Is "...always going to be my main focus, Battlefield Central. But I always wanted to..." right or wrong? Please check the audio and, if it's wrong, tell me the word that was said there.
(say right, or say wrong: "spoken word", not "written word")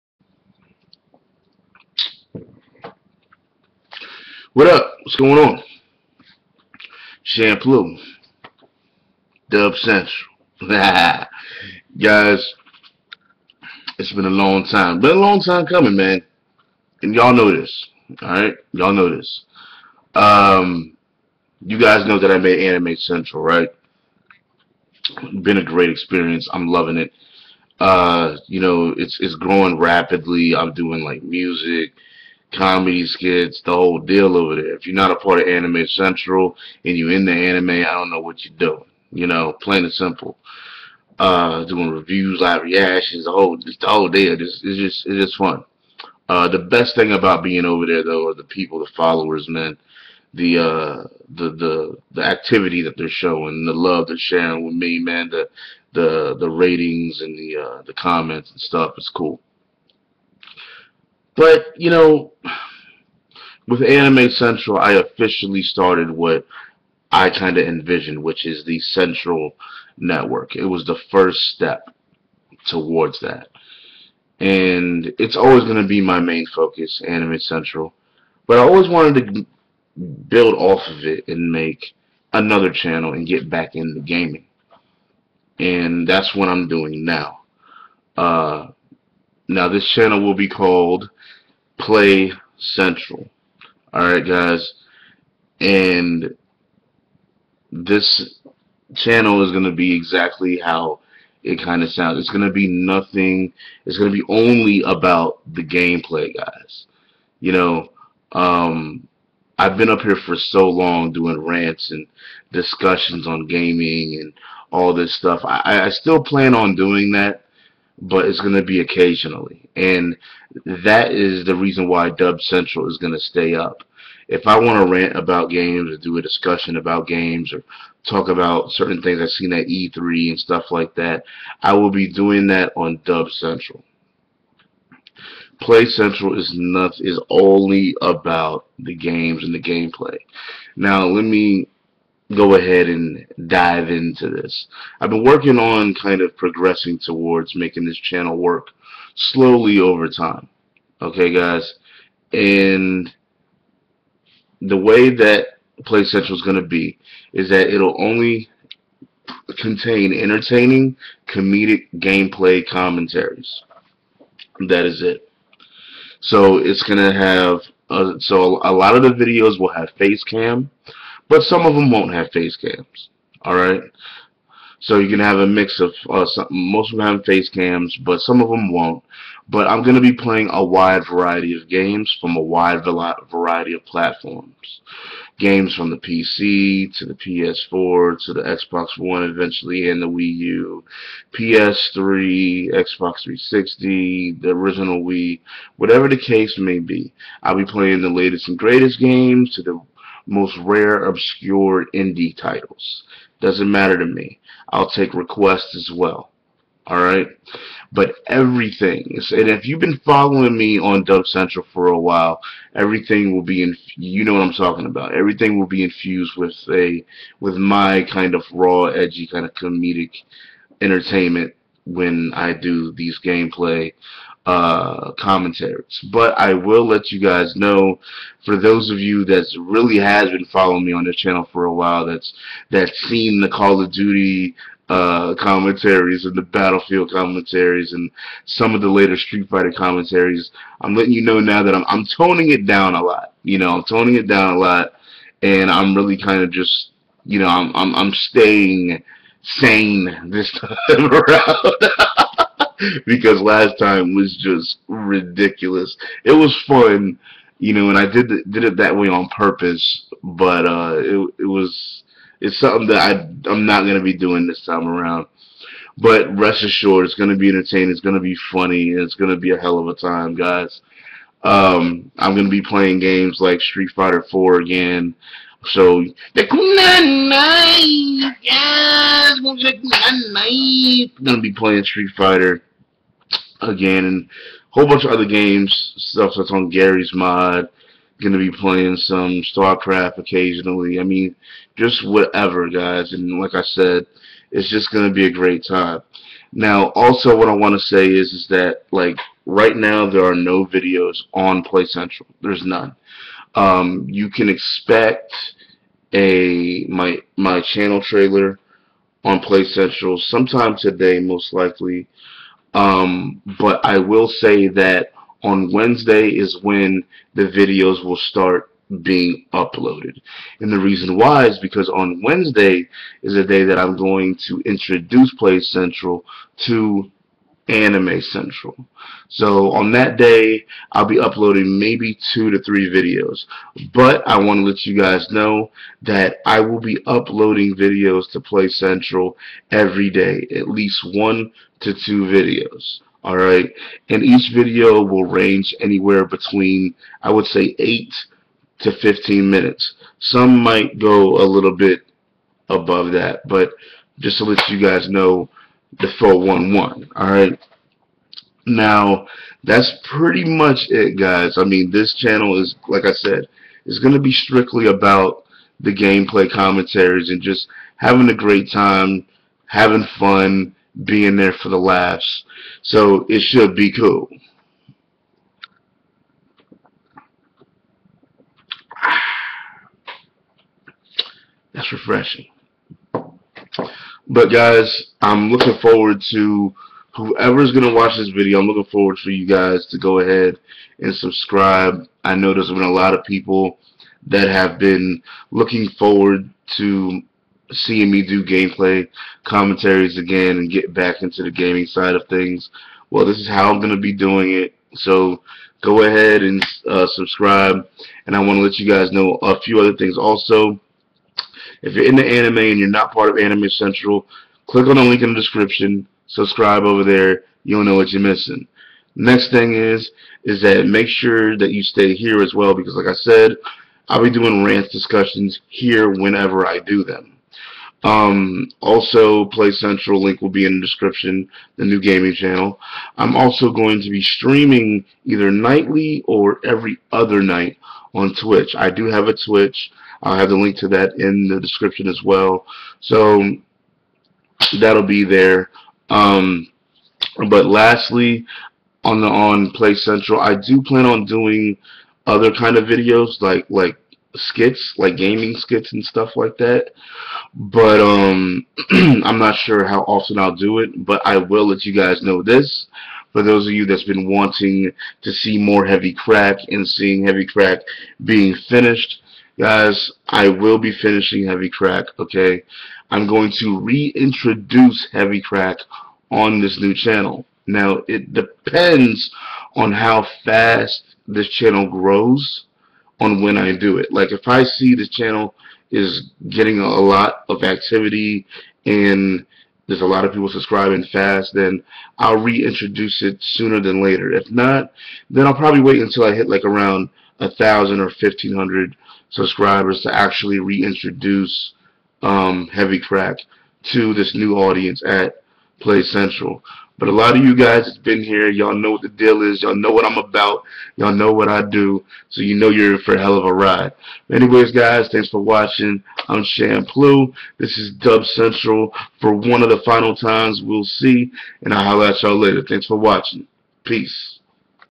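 wrong: "Anime", not "Battlefield".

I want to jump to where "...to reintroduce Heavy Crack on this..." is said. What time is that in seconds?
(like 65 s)
473 s.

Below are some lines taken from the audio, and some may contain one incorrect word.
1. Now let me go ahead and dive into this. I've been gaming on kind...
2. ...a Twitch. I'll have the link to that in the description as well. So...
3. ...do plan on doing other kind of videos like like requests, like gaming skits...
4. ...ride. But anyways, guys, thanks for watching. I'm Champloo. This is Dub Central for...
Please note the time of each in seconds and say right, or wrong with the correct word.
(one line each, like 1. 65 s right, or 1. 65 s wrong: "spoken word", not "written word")
1. 140 s wrong: "working", not "gaming"
2. 439 s right
3. 450 s wrong: "skits", not "requests"
4. 513 s right.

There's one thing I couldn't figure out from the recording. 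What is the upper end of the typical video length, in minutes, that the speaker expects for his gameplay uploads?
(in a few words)
15.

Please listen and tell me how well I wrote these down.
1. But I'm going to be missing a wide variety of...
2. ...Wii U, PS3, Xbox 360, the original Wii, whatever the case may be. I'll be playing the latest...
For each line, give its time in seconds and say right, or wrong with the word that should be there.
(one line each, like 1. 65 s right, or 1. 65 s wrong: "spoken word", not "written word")
1. 179 s wrong: "playing", not "missing"
2. 190 s right.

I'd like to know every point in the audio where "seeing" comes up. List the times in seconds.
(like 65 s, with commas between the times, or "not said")
397 s, 466 s.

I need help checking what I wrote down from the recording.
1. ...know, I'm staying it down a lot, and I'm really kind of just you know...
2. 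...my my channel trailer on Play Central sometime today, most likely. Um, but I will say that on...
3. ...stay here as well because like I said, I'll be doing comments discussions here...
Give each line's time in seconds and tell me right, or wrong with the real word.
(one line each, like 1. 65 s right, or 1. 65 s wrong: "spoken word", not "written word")
1. 243 s wrong: "toning", not "staying"
2. 306 s right
3. 421 s wrong: "rants", not "comments".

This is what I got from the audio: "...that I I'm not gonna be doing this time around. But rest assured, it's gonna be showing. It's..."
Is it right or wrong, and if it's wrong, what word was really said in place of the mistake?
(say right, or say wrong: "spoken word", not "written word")
wrong: "entertaining", not "showing".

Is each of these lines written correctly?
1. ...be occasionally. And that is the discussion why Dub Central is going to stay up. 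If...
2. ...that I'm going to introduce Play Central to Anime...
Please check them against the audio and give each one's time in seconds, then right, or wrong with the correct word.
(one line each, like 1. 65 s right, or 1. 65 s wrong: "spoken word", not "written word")
1. 118 s wrong: "reason", not "discussion"
2. 323 s right.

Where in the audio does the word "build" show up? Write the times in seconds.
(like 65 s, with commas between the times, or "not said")
80 s.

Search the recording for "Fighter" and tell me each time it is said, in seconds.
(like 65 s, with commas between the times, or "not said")
239 s, 273 s, 282 s.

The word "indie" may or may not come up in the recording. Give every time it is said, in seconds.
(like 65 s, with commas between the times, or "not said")
201 s.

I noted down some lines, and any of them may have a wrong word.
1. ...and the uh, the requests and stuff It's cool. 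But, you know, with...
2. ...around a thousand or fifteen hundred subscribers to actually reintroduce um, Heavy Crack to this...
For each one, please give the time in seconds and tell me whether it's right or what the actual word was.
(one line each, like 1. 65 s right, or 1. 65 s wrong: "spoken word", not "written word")
1. 57 s wrong: "comments", not "requests"
2. 496 s right.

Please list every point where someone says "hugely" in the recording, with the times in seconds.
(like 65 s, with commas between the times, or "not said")
not said.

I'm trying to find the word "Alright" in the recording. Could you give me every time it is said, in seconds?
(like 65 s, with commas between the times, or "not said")
18 s, 93 s, 173 s, 206 s, 343 s.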